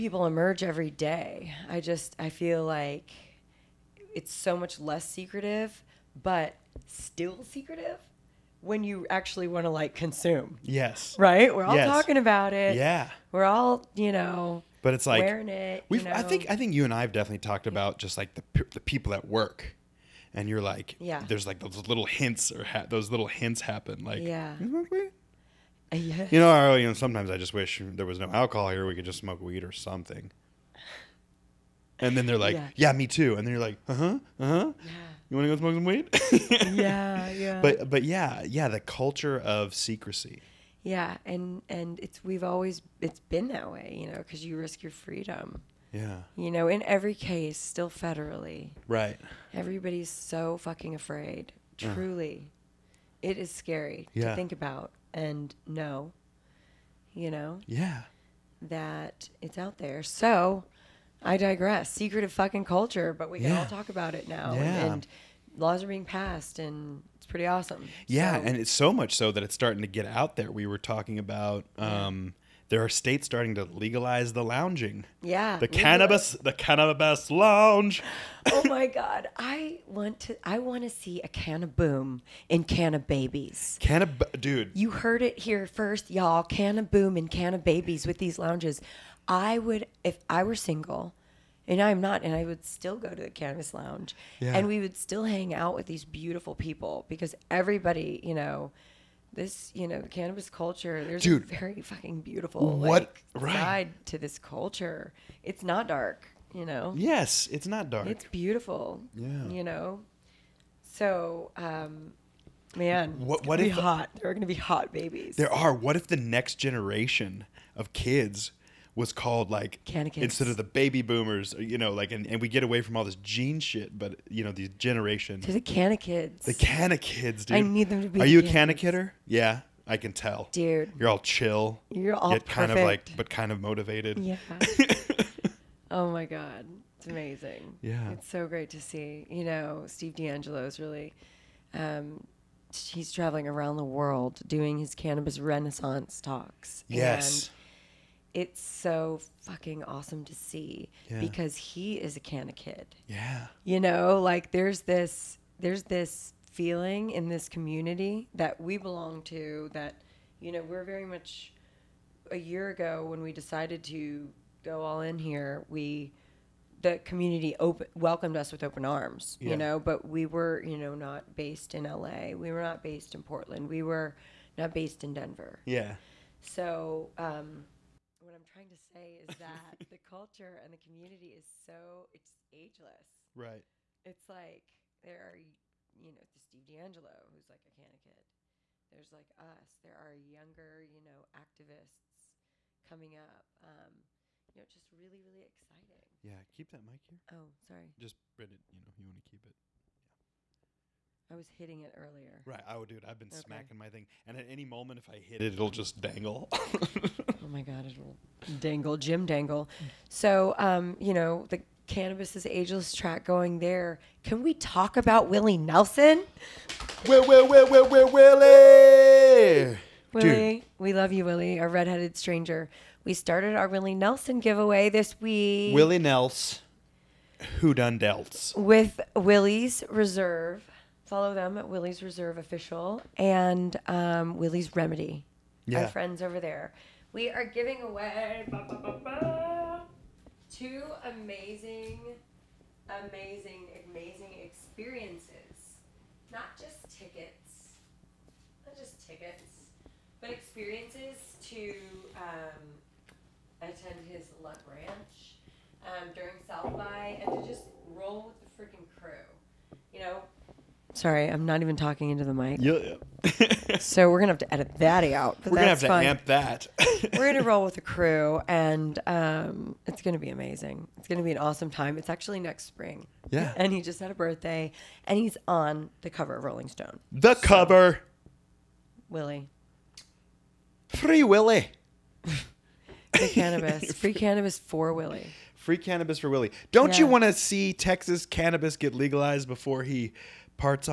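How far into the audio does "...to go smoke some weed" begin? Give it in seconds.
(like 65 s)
35 s.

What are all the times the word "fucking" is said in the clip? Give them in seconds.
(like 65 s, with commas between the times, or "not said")
50 s, 62 s, 101 s, 149 s.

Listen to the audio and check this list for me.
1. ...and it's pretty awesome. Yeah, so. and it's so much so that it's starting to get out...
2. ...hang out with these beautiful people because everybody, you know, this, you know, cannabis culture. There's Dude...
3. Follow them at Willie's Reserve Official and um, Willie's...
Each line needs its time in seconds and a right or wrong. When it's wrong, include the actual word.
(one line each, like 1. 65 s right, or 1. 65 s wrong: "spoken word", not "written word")
1. 66 s right
2. 95 s right
3. 231 s right.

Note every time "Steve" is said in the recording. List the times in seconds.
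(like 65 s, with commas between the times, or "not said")
139 s, 186 s.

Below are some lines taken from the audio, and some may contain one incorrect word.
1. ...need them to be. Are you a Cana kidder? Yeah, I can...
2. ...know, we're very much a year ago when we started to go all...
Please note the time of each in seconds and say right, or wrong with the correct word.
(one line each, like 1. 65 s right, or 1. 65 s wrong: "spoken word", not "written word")
1. 127 s right
2. 160 s wrong: "decided", not "started".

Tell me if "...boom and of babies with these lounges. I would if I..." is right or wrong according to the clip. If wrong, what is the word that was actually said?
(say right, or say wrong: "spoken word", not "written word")
right.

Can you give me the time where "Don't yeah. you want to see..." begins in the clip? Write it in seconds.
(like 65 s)
286 s.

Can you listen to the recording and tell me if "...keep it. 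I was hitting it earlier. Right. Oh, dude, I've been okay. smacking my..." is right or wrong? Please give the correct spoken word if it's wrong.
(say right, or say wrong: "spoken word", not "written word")
right.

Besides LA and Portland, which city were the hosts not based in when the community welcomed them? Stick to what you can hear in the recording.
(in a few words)
Denver.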